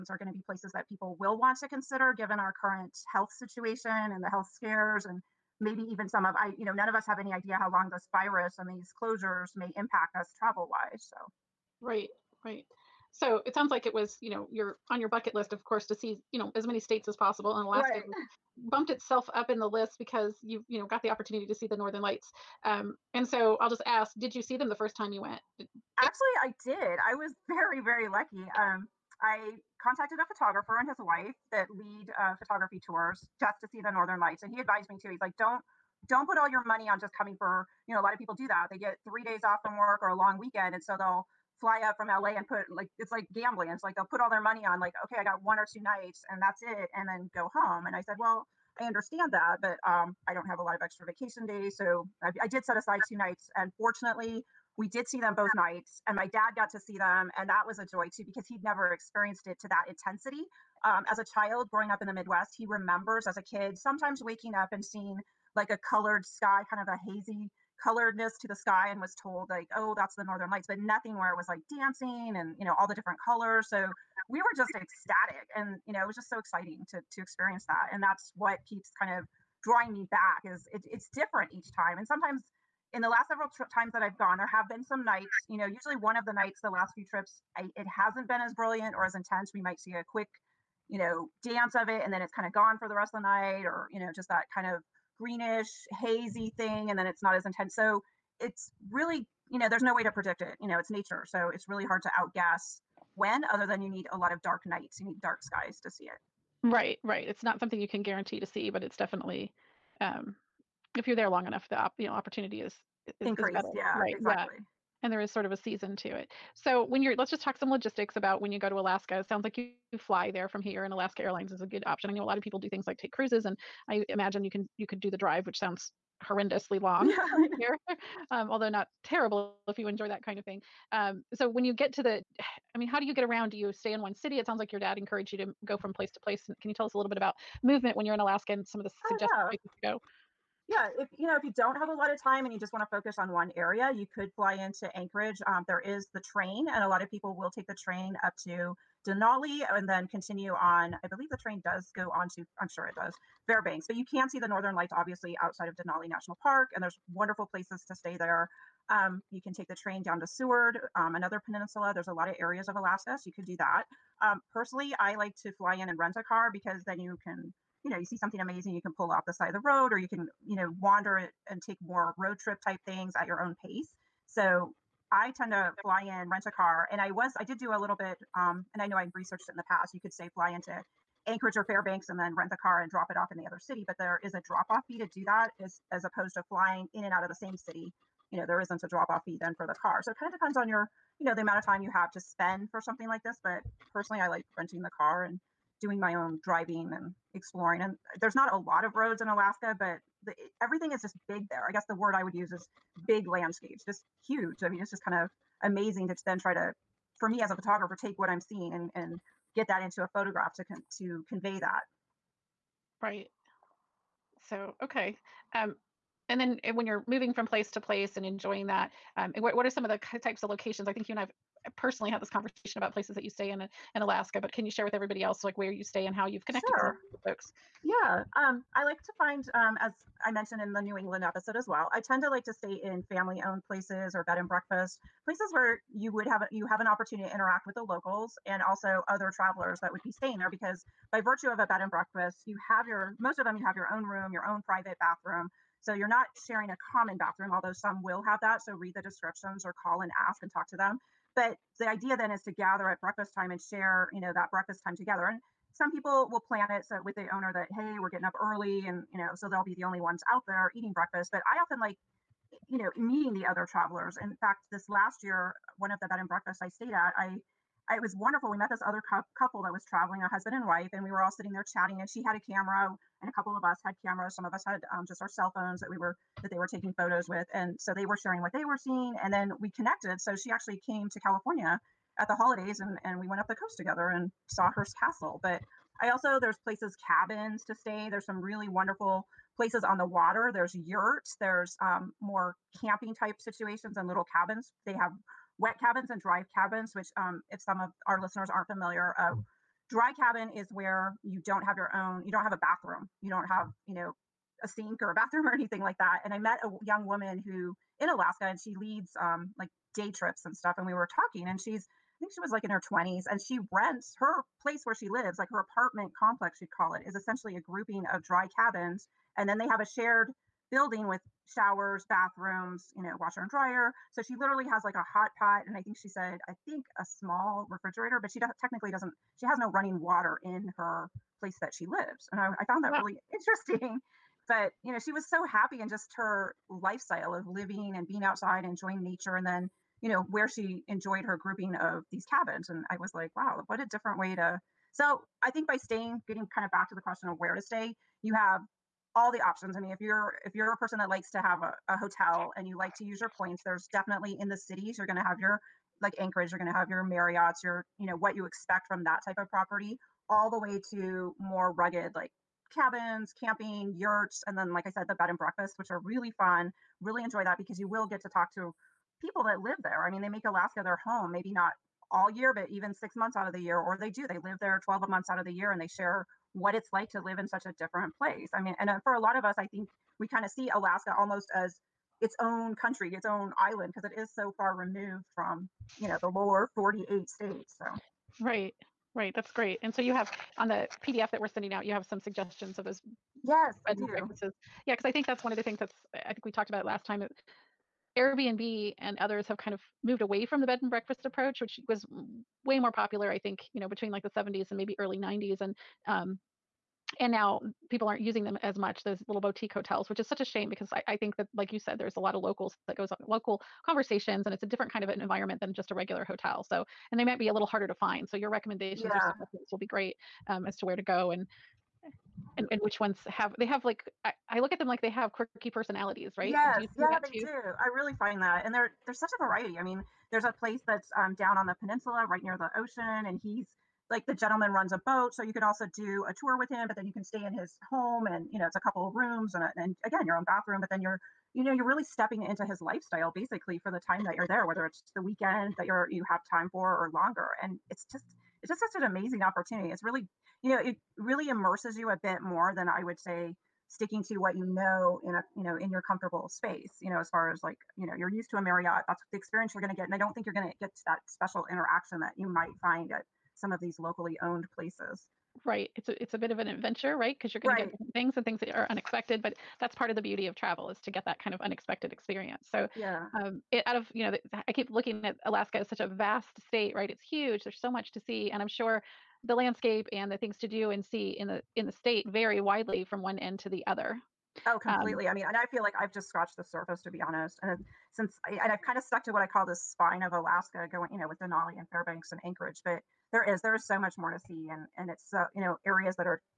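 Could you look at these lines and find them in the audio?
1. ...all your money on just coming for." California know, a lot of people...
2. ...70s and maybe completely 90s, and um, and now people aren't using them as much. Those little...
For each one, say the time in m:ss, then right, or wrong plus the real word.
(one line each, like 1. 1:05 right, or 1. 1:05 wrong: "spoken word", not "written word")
1. 0:36 wrong: "You", not "California"
2. 6:44 wrong: "early", not "completely".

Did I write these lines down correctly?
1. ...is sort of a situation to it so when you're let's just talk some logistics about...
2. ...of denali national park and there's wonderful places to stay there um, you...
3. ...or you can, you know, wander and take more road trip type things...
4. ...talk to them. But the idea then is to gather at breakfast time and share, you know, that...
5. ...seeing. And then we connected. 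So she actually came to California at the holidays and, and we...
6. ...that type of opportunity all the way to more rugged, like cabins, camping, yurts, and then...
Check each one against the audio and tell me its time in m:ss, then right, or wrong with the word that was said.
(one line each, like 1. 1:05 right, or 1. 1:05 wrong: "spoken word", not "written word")
1. 1:55 wrong: "season", not "situation"
2. 2:35 right
3. 2:49 right
4. 4:10 right
5. 4:38 right
6. 5:59 wrong: "property", not "opportunity".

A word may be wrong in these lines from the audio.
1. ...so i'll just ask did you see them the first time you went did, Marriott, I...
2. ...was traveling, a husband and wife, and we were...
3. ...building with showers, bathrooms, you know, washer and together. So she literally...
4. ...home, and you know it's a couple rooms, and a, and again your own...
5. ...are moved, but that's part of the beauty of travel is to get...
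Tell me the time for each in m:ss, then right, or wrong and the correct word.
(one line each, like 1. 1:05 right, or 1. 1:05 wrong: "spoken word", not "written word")
1. 0:23 wrong: "Actually", not "Marriott"
2. 4:29 right
3. 5:20 wrong: "dryer", not "together"
4. 7:17 right
5. 7:48 wrong: "unexpected", not "moved".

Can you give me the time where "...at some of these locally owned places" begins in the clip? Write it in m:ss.
7:43.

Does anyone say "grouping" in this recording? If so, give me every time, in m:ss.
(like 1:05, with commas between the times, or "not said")
5:17, 5:41.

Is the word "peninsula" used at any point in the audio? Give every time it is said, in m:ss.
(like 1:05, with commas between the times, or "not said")
2:41, 7:11.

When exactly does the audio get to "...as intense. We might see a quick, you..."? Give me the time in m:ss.
1:29.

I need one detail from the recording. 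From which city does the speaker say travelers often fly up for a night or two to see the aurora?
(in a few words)
LA.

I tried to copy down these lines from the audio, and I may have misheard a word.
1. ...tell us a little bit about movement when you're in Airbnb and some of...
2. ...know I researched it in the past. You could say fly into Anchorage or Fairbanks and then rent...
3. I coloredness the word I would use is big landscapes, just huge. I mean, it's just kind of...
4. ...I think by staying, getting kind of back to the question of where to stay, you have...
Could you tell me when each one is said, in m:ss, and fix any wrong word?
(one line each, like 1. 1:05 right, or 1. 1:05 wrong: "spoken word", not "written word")
1. 2:16 wrong: "Alaska", not "Airbnb"
2. 2:58 right
3. 3:21 wrong: "guess", not "coloredness"
4. 5:45 right.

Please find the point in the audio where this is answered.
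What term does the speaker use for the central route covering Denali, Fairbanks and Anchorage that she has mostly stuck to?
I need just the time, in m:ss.
8:09.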